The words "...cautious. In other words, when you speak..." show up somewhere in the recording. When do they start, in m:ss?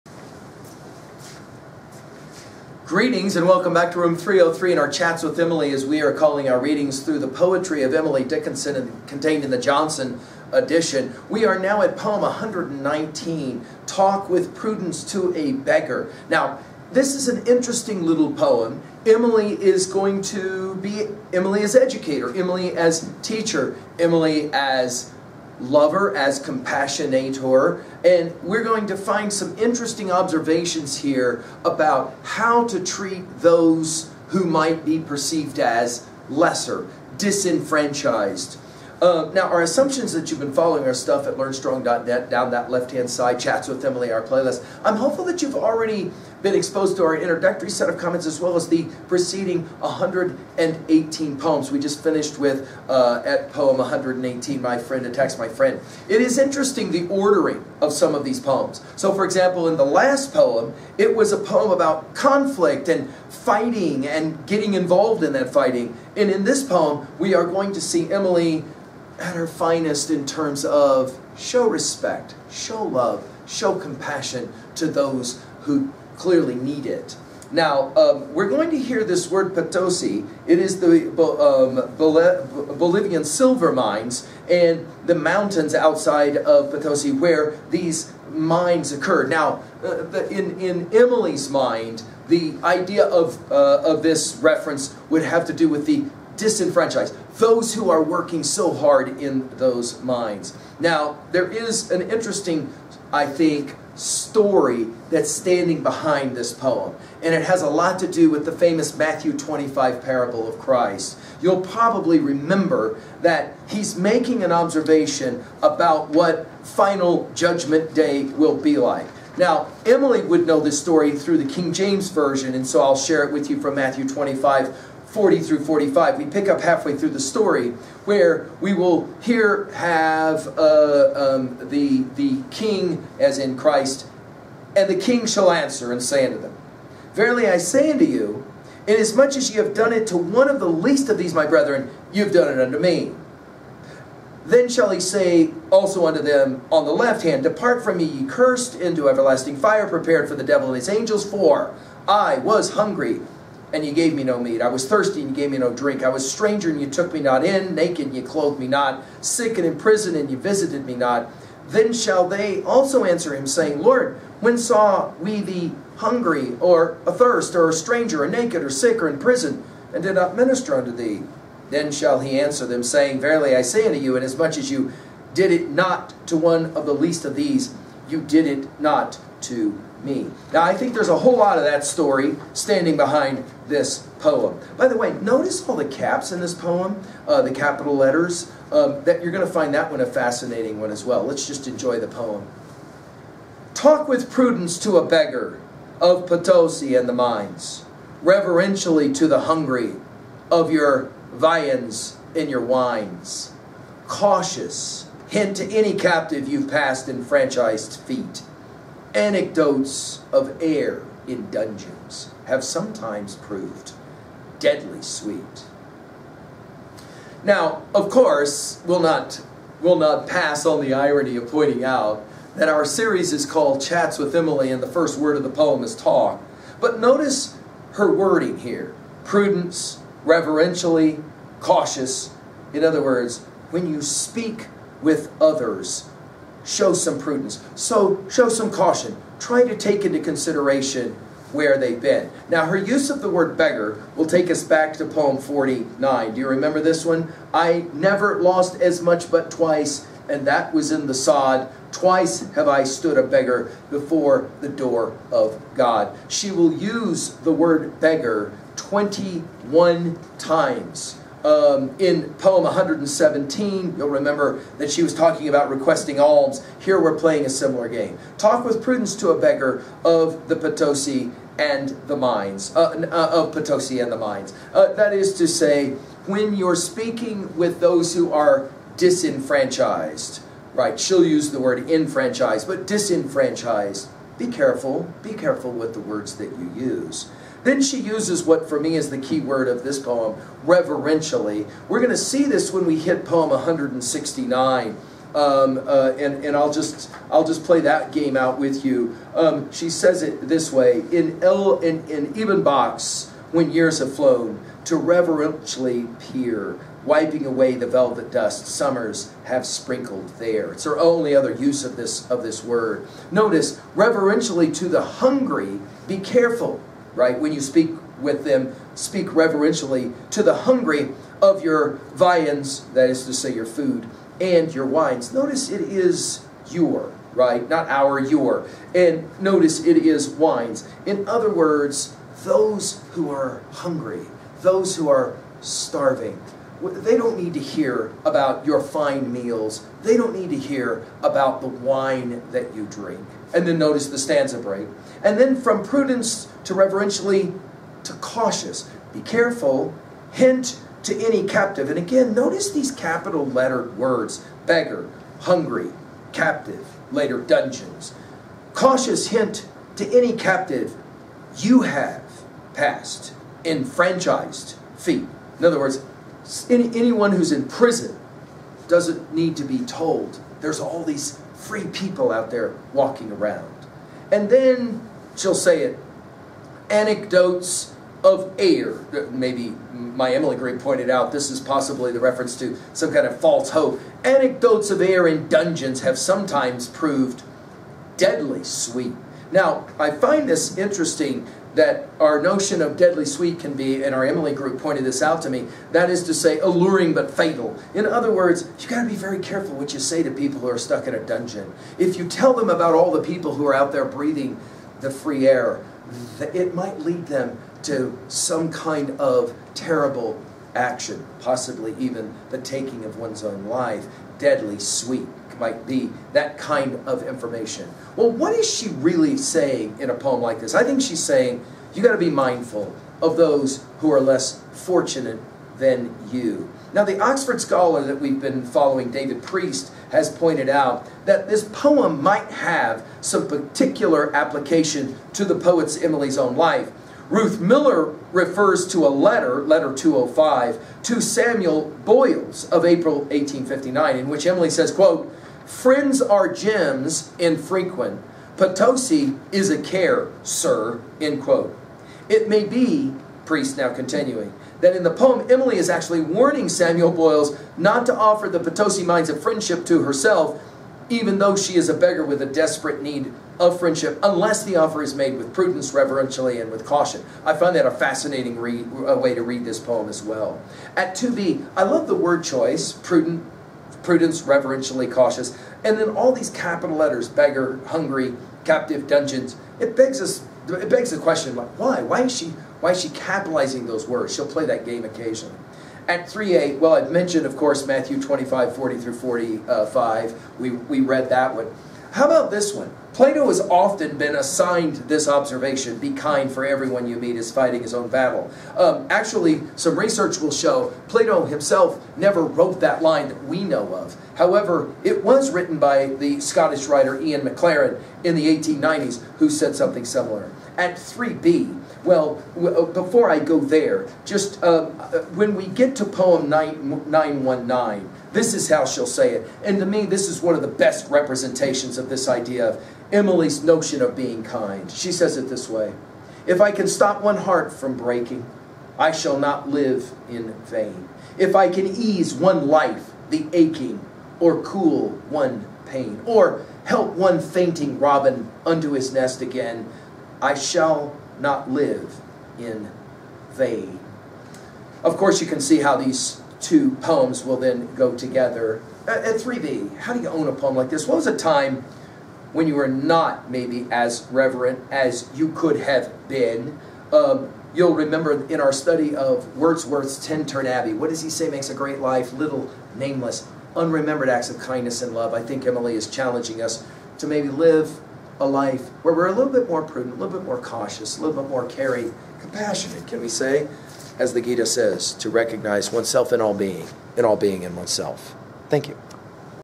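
3:51.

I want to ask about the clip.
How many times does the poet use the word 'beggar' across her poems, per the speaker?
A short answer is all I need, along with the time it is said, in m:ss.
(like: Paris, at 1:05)
21, at 4:18.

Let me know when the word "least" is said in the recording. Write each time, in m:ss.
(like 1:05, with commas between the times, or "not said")
2:20, 2:56.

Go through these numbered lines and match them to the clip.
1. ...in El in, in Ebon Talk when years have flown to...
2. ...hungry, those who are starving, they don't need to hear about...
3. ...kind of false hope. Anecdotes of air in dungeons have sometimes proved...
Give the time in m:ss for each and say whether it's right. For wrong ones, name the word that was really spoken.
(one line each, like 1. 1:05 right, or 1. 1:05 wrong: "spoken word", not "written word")
1. 5:01 wrong: "Box", not "Talk"
2. 5:33 right
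3. 6:23 right.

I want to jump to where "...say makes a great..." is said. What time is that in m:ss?
9:21.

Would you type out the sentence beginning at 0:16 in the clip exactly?
Now, this is an interesting little poem.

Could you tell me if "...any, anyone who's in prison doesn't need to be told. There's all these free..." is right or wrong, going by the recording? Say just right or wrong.
right.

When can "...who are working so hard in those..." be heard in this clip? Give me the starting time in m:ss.
1:37.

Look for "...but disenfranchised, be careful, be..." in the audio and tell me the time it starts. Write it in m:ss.
4:42.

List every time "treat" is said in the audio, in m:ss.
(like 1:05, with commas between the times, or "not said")
0:32.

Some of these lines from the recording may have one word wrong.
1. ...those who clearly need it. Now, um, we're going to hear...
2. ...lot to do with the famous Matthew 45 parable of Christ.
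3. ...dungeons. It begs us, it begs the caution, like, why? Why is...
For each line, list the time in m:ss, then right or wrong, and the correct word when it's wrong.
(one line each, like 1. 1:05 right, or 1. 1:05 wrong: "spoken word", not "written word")
1. 1:14 right
2. 1:47 wrong: "25", not "45"
3. 7:59 wrong: "question", not "caution".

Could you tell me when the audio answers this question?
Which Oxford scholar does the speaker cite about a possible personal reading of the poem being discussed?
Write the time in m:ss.
7:09.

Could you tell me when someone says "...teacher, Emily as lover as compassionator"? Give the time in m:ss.
0:23.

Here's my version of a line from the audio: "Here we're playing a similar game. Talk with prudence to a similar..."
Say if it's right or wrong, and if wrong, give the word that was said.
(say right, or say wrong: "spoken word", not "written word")
wrong: "beggar", not "similar".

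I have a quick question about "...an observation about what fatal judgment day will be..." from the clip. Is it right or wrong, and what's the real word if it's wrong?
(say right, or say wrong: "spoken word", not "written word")
wrong: "final", not "fatal".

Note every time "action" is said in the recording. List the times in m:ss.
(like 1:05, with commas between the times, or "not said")
6:50.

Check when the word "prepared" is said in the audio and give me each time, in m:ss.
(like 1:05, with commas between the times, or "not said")
2:29.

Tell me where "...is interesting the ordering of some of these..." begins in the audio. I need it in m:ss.
0:56.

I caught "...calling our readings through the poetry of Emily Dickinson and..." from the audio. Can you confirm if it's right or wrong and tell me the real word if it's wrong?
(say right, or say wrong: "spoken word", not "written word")
right.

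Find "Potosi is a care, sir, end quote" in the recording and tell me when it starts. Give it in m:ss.
7:28.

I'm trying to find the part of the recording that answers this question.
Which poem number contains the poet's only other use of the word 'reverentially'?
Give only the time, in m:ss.
4:53.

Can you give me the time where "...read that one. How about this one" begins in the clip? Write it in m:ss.
8:10.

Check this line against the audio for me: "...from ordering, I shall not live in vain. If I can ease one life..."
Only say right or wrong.
wrong.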